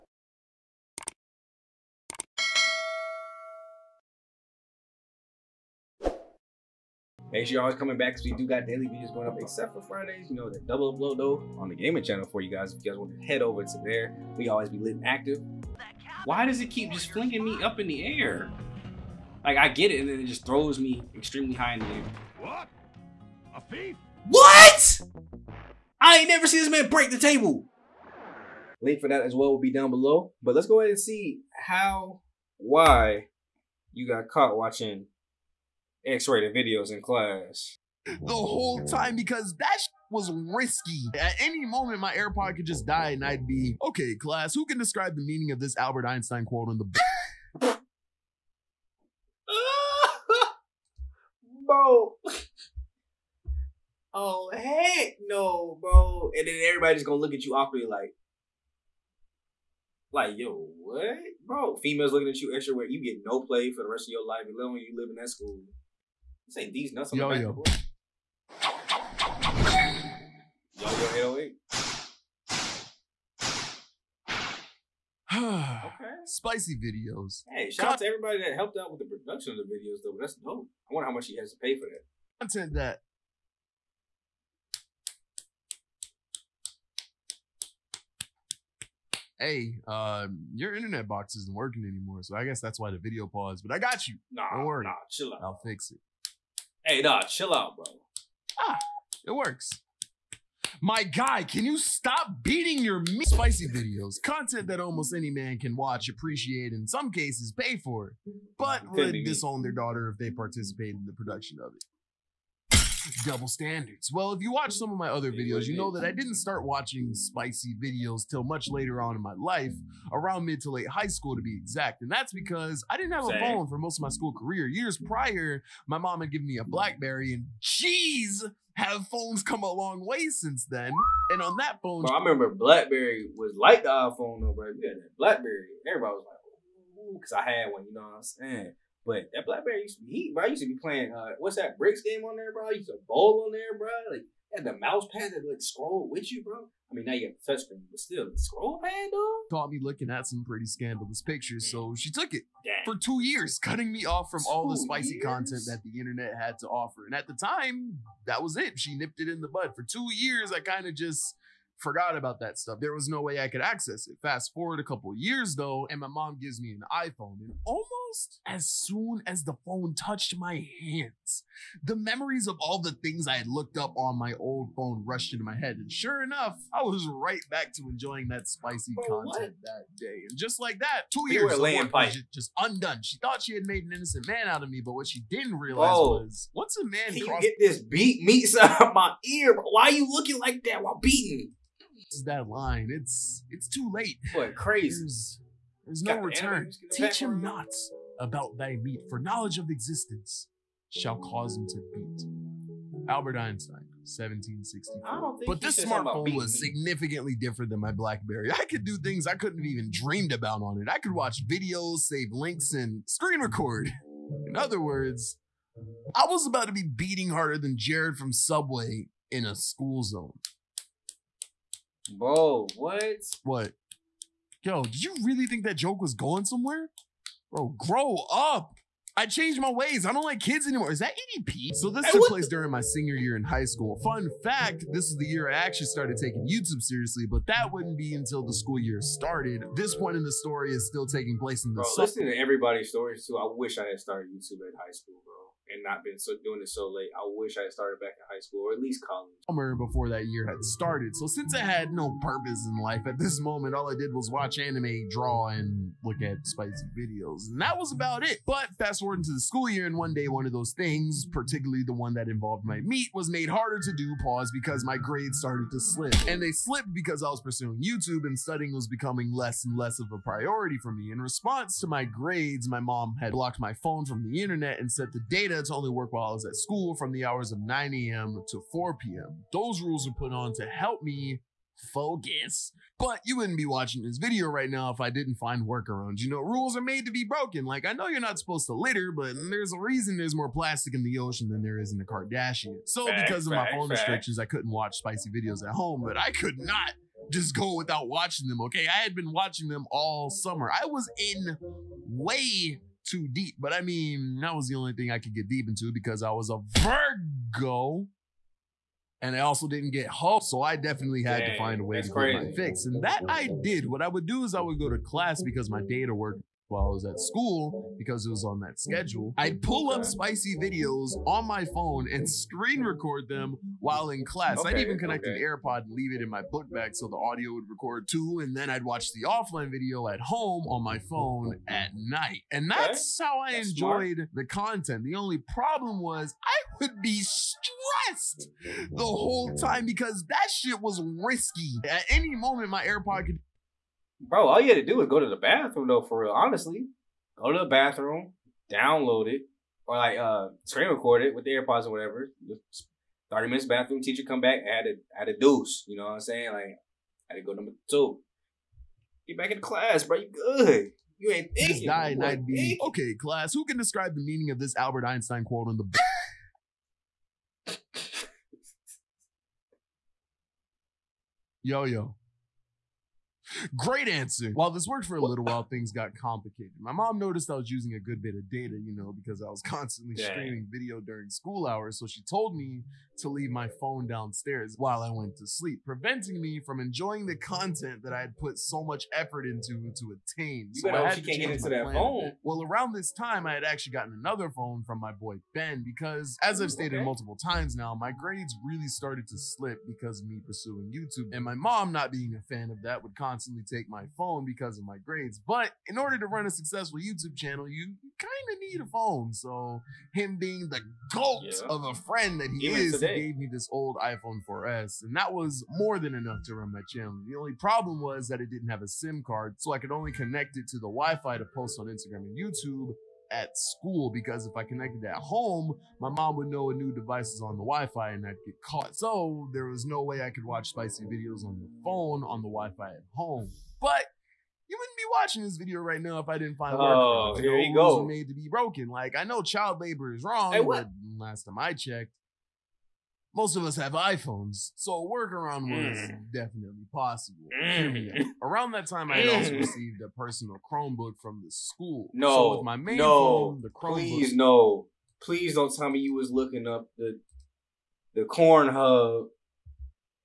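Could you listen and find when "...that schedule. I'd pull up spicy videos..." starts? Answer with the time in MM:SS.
05:18.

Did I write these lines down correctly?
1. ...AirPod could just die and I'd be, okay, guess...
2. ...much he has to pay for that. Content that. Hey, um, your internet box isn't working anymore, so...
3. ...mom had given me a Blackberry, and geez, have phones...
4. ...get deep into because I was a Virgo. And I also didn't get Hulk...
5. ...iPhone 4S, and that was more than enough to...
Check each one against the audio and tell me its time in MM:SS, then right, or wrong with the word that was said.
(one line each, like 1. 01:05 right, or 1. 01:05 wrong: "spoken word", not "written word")
1. 00:42 wrong: "class", not "guess"
2. 01:21 right
3. 02:05 right
4. 05:05 right
5. 06:53 right.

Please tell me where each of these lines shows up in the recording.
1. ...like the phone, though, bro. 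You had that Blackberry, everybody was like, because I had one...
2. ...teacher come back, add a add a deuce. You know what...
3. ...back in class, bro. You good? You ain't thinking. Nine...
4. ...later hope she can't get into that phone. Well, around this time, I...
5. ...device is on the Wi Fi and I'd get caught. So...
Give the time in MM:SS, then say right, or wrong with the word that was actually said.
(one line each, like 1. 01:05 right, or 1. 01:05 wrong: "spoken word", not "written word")
1. 02:13 wrong: "iPhone", not "phone"
2. 05:54 right
3. 05:59 right
4. 06:30 wrong: "better", not "later"
5. 07:06 right.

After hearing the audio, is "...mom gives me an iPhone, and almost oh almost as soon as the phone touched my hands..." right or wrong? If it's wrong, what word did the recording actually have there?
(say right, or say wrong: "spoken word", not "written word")
right.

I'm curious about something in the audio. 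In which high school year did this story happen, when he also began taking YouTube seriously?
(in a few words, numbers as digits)
Senior year.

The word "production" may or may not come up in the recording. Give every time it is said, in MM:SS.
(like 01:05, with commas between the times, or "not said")
01:19, 01:51.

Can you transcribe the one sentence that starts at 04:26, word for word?
And they slipped because I was pursuing YouTube and studying was becoming less and less of a priority for me.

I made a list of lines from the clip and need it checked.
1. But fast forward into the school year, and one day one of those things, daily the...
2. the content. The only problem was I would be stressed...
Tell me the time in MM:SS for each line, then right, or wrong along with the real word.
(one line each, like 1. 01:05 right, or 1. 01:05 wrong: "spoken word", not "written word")
1. 04:18 wrong: "particularly", not "daily"
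2. 05:34 right.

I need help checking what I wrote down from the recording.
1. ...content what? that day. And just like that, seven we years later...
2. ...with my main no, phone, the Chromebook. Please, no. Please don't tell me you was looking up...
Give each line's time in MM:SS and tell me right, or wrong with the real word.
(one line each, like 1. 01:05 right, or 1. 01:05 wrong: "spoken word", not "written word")
1. 02:59 wrong: "two", not "seven"
2. 07:32 right.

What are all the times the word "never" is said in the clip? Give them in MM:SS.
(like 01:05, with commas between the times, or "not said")
00:26.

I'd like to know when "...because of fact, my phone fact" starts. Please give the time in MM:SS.
04:53.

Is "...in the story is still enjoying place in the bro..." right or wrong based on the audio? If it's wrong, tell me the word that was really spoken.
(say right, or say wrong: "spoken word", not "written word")
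wrong: "taking", not "enjoying".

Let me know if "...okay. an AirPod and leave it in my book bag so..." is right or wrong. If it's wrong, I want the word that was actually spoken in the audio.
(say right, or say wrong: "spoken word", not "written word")
right.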